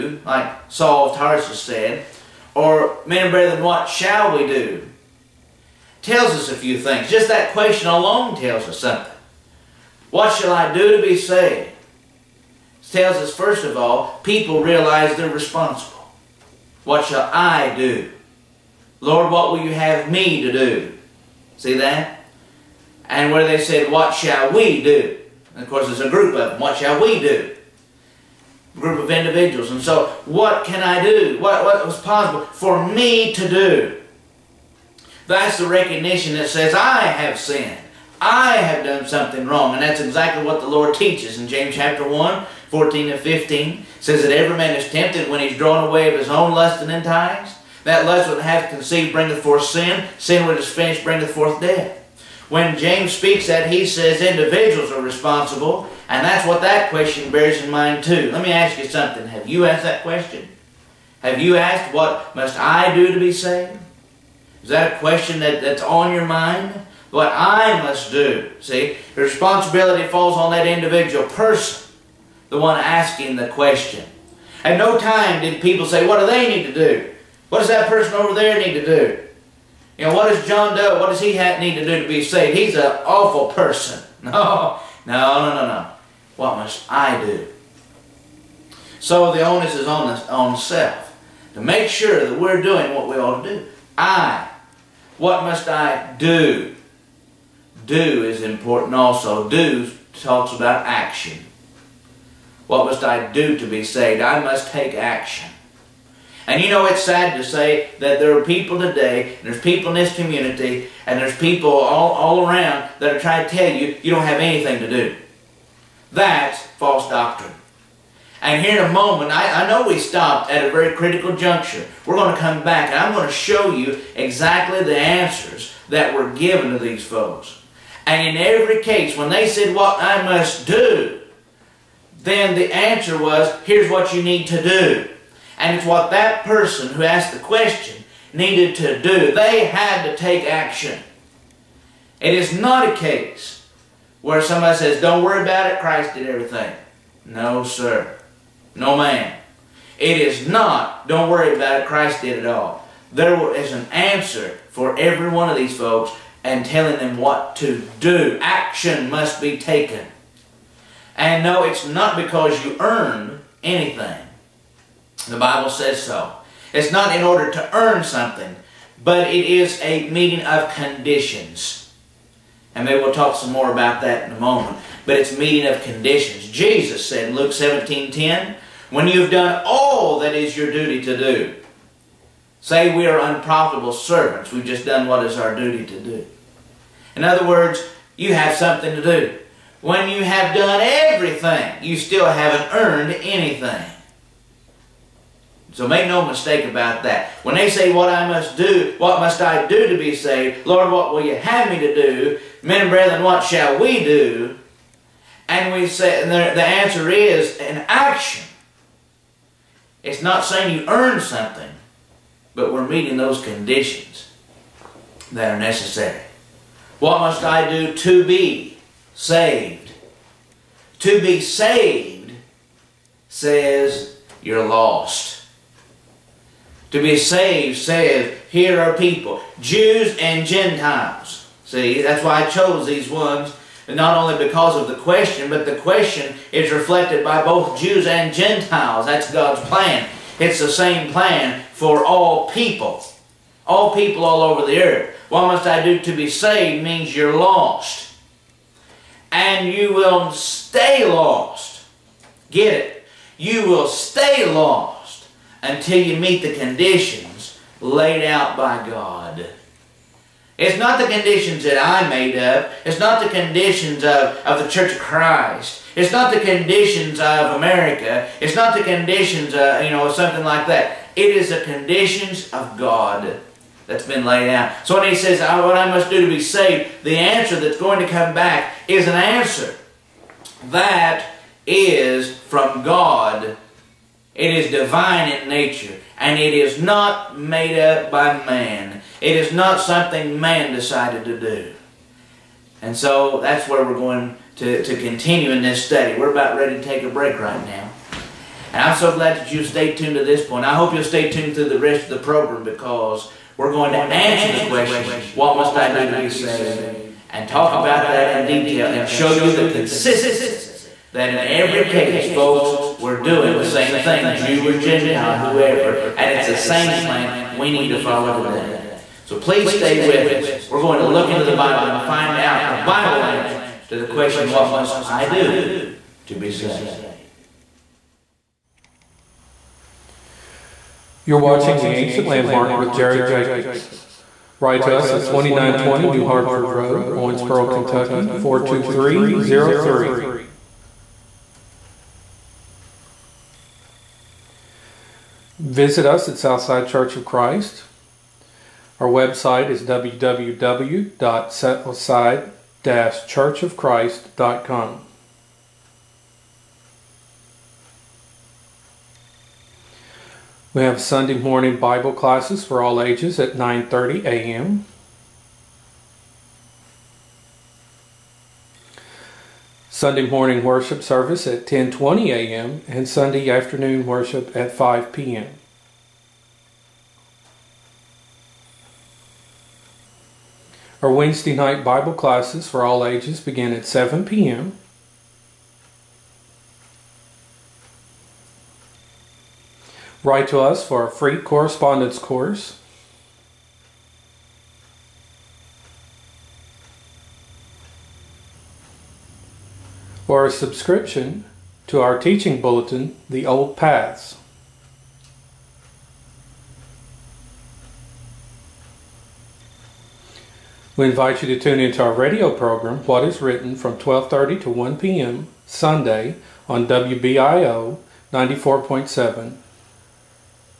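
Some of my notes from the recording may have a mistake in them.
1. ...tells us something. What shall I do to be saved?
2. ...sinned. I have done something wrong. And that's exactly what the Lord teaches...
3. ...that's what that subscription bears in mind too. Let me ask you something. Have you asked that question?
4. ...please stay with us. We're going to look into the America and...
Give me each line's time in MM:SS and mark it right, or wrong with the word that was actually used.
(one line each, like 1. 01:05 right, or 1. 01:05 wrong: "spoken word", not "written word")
1. 00:08 right
2. 00:37 right
3. 00:56 wrong: "question", not "subscription"
4. 05:19 wrong: "Bible", not "America".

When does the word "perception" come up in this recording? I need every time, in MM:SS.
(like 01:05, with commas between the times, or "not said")
not said.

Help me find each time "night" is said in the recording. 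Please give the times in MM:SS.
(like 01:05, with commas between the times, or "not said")
06:21.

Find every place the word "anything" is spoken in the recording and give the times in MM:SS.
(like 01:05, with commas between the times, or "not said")
01:54, 02:43, 03:13.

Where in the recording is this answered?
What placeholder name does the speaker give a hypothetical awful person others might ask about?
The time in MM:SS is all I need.
01:20.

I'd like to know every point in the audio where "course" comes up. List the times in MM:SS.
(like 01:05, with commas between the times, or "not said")
00:25, 06:32.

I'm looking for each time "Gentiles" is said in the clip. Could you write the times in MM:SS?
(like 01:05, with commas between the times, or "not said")
03:50, 03:58, 05:14.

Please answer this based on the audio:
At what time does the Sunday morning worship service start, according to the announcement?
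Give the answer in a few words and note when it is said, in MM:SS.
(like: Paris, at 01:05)
10:20 a.m., at 06:11.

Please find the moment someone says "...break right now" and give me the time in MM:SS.
04:57.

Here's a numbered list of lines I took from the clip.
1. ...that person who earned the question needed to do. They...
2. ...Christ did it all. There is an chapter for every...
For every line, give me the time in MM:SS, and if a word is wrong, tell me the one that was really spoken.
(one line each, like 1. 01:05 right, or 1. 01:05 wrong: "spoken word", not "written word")
1. 02:16 wrong: "asked", not "earned"
2. 02:31 wrong: "answer", not "chapter".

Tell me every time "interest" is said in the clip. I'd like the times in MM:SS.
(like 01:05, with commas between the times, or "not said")
not said.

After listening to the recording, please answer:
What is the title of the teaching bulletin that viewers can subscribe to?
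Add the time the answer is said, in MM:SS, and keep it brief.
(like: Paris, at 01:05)
The Old Paths, at 06:43.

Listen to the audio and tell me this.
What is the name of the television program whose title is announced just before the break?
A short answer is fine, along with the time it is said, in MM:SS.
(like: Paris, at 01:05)
The Ancient Landmark, at 05:31.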